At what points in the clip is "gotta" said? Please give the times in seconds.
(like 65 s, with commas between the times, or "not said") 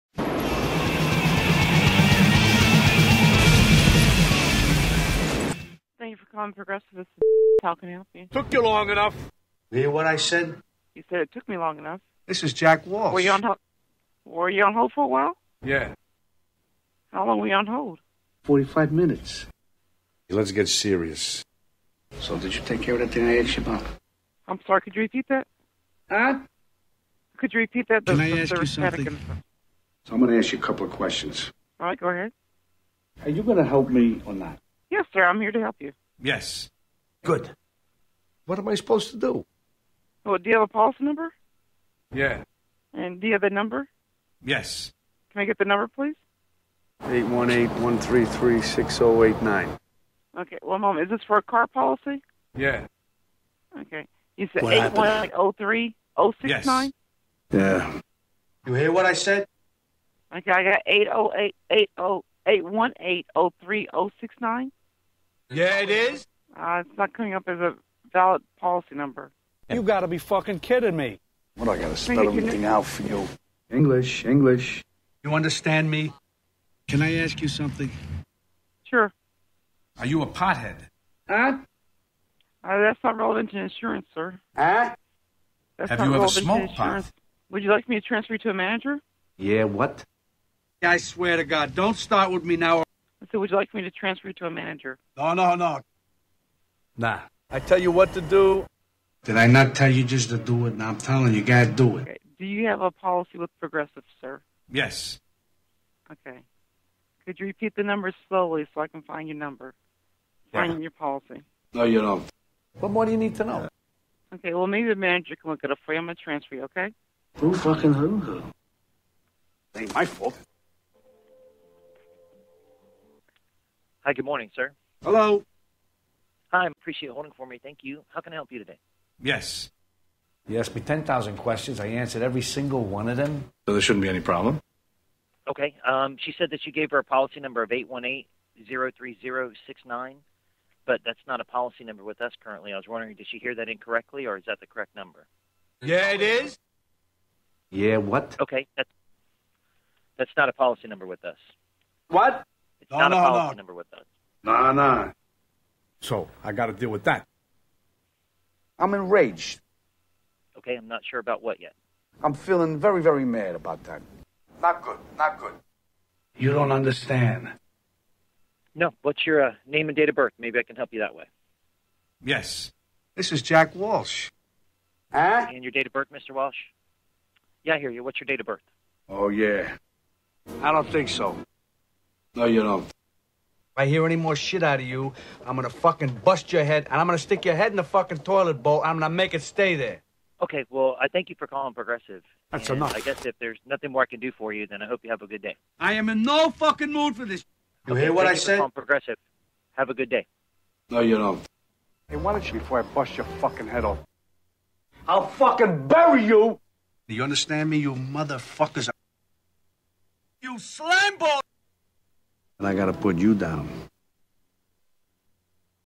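101 s, 212 s.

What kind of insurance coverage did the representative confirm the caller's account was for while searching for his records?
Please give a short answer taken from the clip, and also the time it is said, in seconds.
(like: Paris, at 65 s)
Car, at 51 s.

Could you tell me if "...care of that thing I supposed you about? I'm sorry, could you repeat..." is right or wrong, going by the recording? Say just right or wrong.
wrong.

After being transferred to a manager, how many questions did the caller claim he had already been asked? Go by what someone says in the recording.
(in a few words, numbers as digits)
10,000.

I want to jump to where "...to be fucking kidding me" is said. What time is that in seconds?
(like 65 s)
70 s.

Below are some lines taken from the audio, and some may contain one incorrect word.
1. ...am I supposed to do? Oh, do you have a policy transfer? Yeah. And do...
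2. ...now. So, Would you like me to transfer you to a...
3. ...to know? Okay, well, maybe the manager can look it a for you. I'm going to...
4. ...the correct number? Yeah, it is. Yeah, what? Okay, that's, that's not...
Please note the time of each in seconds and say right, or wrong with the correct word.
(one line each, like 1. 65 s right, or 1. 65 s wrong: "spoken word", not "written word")
1. 38 s wrong: "number", not "transfer"
2. 92 s right
3. 113 s right
4. 144 s right.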